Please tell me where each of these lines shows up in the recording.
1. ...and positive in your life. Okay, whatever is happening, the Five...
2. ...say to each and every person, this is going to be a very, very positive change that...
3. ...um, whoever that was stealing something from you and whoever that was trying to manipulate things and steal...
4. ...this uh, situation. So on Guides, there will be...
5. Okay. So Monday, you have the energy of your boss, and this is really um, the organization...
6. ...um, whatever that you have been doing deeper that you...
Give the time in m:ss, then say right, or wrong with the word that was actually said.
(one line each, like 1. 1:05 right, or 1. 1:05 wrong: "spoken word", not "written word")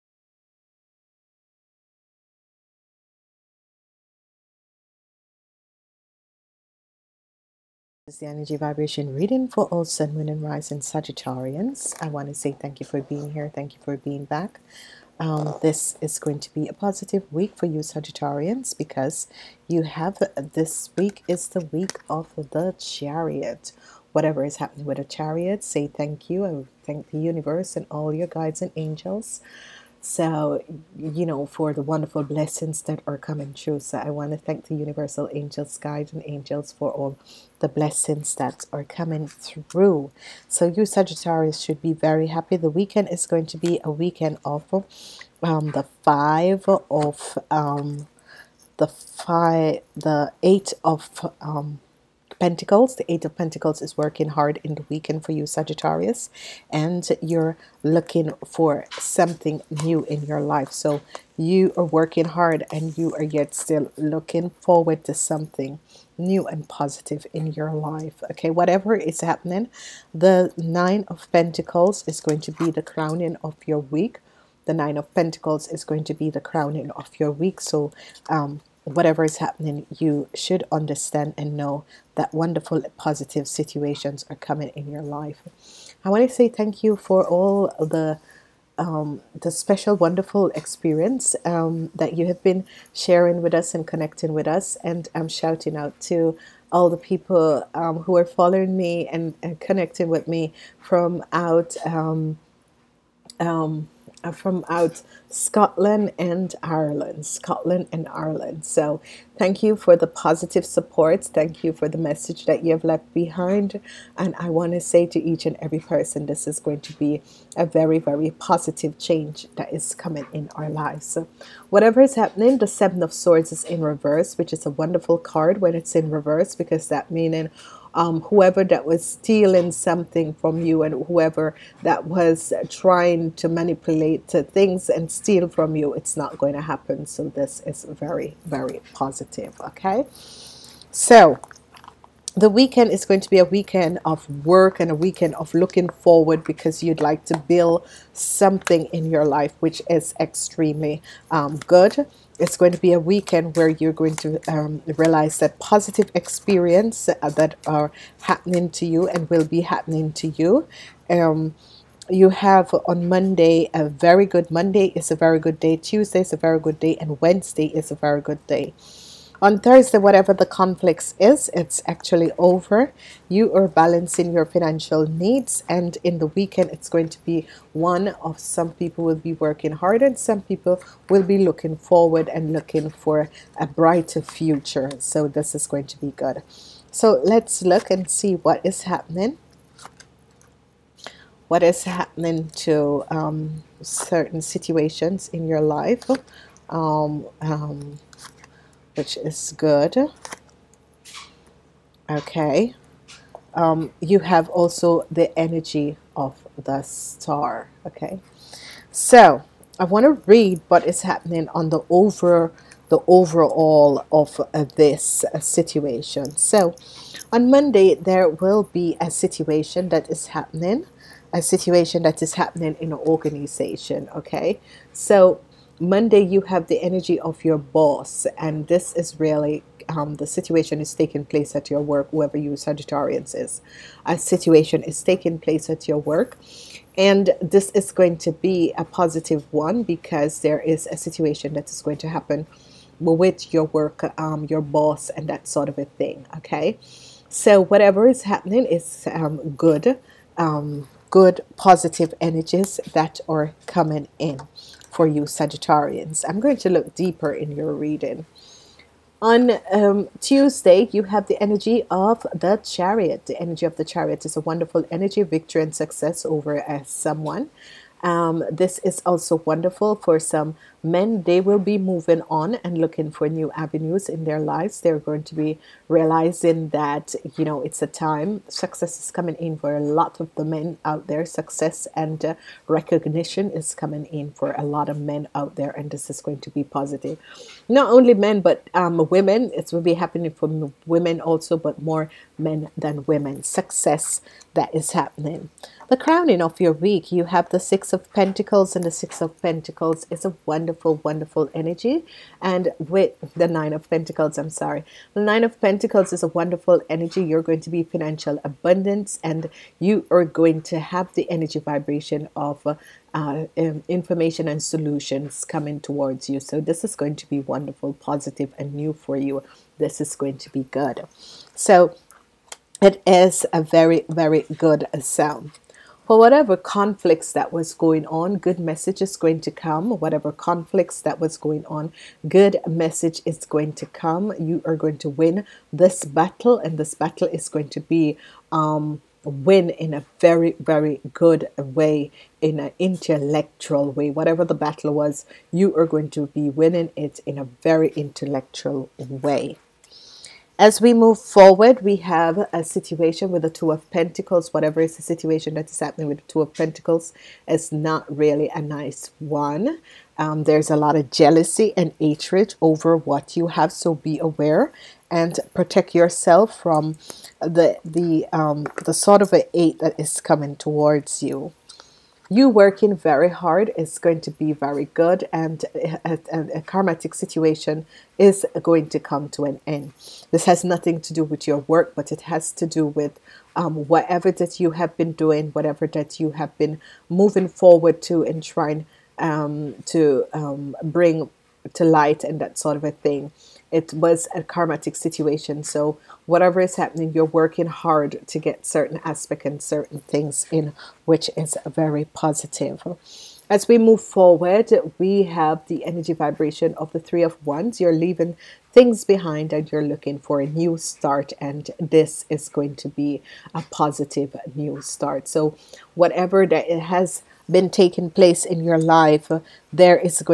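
1. 1:06 wrong: "Nine", not "Five"
2. 1:54 right
3. 2:07 right
4. 3:34 wrong: "Monday", not "Guides"
5. 3:44 wrong: "situation", not "organization"
6. 6:23 wrong: "whatever", not "deeper".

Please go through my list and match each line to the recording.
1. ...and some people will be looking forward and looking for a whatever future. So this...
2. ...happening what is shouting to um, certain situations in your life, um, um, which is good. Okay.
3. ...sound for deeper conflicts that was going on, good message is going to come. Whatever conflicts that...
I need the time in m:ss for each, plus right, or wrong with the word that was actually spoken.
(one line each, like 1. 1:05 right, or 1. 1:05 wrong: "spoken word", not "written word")
1. 3:00 wrong: "brighter", not "whatever"
2. 3:08 wrong: "happening", not "shouting"
3. 5:24 wrong: "whatever", not "deeper".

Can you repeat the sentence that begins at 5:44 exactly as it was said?
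Whatever the battle was, you are going to be winning it in a very intellectual way.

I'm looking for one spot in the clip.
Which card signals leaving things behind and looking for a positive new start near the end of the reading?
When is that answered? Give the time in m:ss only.
6:46.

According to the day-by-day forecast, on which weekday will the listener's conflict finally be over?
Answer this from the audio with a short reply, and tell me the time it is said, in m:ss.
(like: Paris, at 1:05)
Thursday, at 2:49.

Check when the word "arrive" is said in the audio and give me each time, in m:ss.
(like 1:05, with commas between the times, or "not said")
not said.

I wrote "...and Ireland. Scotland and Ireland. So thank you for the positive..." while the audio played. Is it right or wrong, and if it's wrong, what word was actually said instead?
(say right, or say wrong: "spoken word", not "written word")
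right.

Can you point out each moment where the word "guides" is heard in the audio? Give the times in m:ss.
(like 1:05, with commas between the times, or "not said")
0:28, 0:35.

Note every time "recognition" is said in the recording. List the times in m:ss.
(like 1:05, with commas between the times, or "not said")
4:42.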